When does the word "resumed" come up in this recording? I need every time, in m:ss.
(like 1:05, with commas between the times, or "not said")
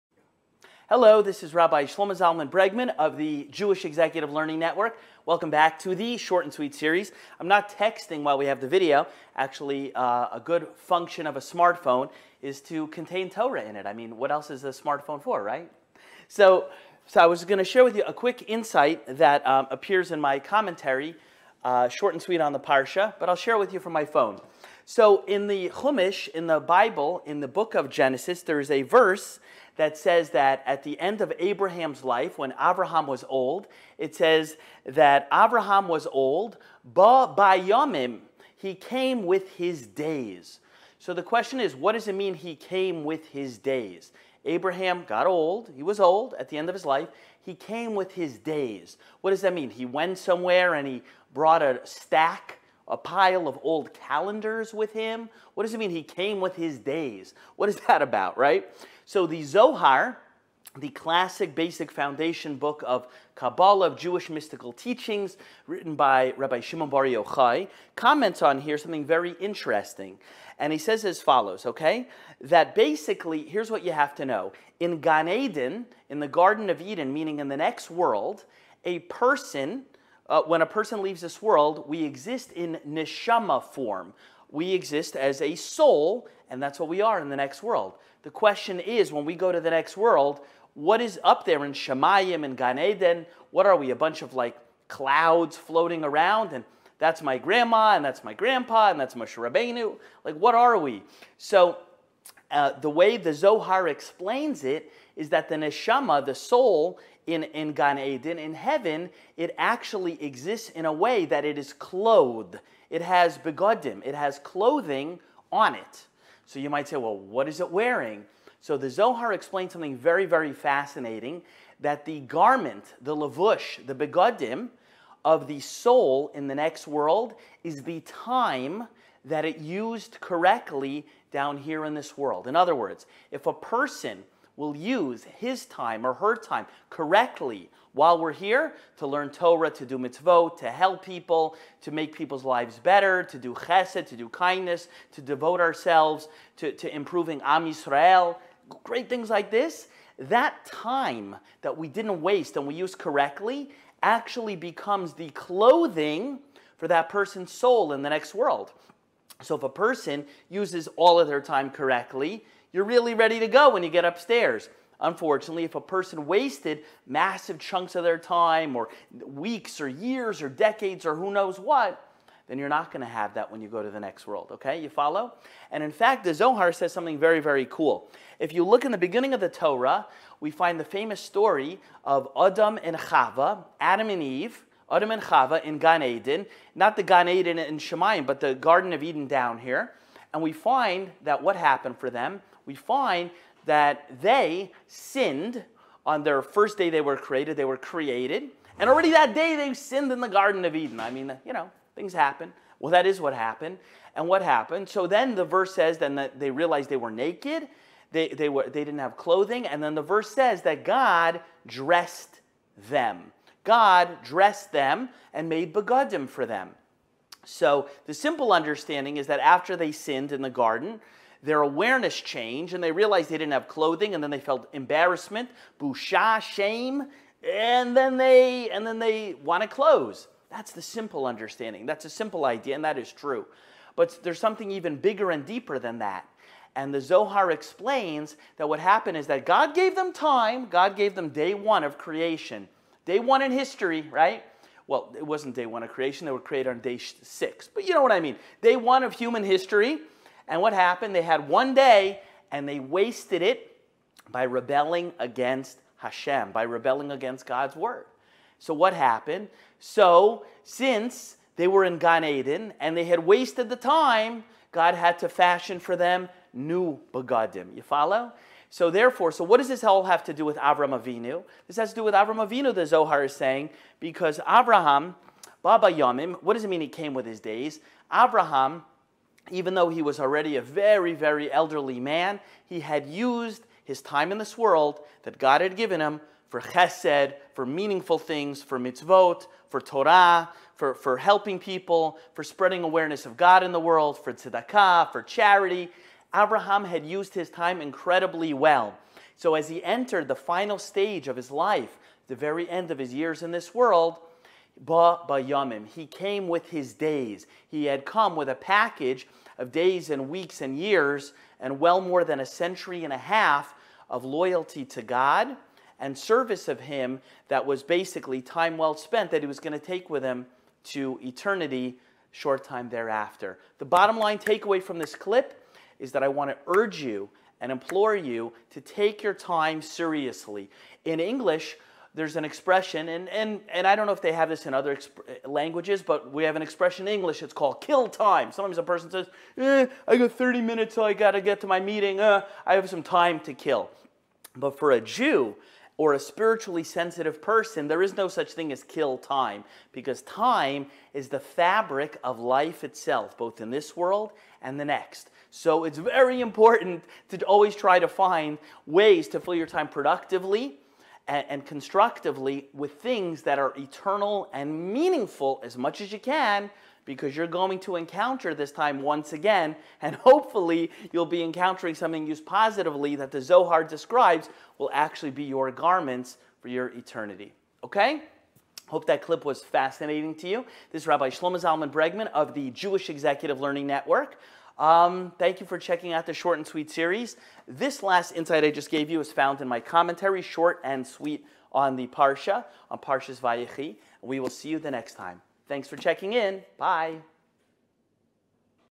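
not said.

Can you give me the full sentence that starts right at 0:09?
Actually, uh, a good function of a smartphone is to contain Torah in it.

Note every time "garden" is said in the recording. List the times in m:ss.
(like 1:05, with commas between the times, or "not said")
1:16, 3:08, 3:20, 3:40.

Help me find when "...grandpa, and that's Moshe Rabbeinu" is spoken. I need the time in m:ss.
1:38.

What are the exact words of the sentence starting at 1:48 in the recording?
In heaven, it actually exists in a way that it is clothed.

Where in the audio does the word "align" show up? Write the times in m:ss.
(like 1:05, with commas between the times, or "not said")
not said.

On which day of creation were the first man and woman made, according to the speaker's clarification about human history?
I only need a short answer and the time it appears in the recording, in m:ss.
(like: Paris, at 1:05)
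Day six, at 4:06.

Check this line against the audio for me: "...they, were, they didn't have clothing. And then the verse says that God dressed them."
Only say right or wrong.
right.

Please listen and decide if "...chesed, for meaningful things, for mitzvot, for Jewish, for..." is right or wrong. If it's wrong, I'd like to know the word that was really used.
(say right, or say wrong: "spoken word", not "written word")
wrong: "Torah", not "Jewish".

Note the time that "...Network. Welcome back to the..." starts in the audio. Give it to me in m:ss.
0:04.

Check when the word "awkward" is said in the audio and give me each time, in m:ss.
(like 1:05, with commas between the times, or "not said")
not said.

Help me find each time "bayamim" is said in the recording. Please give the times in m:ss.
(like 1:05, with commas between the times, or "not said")
0:37, 4:35, 5:05.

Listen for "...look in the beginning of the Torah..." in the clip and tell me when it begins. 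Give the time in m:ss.
2:58.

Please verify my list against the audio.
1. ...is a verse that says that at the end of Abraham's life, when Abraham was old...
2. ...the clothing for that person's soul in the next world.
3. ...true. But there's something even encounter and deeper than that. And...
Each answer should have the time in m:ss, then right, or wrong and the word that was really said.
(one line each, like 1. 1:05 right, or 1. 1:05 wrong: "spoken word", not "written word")
1. 0:28 right
2. 2:35 right
3. 3:53 wrong: "bigger", not "encounter".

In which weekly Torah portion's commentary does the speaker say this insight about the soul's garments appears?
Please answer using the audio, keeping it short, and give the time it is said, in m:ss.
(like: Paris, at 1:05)
Vayechi, at 6:33.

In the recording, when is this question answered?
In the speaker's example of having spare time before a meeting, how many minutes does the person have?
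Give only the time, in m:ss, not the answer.
5:40.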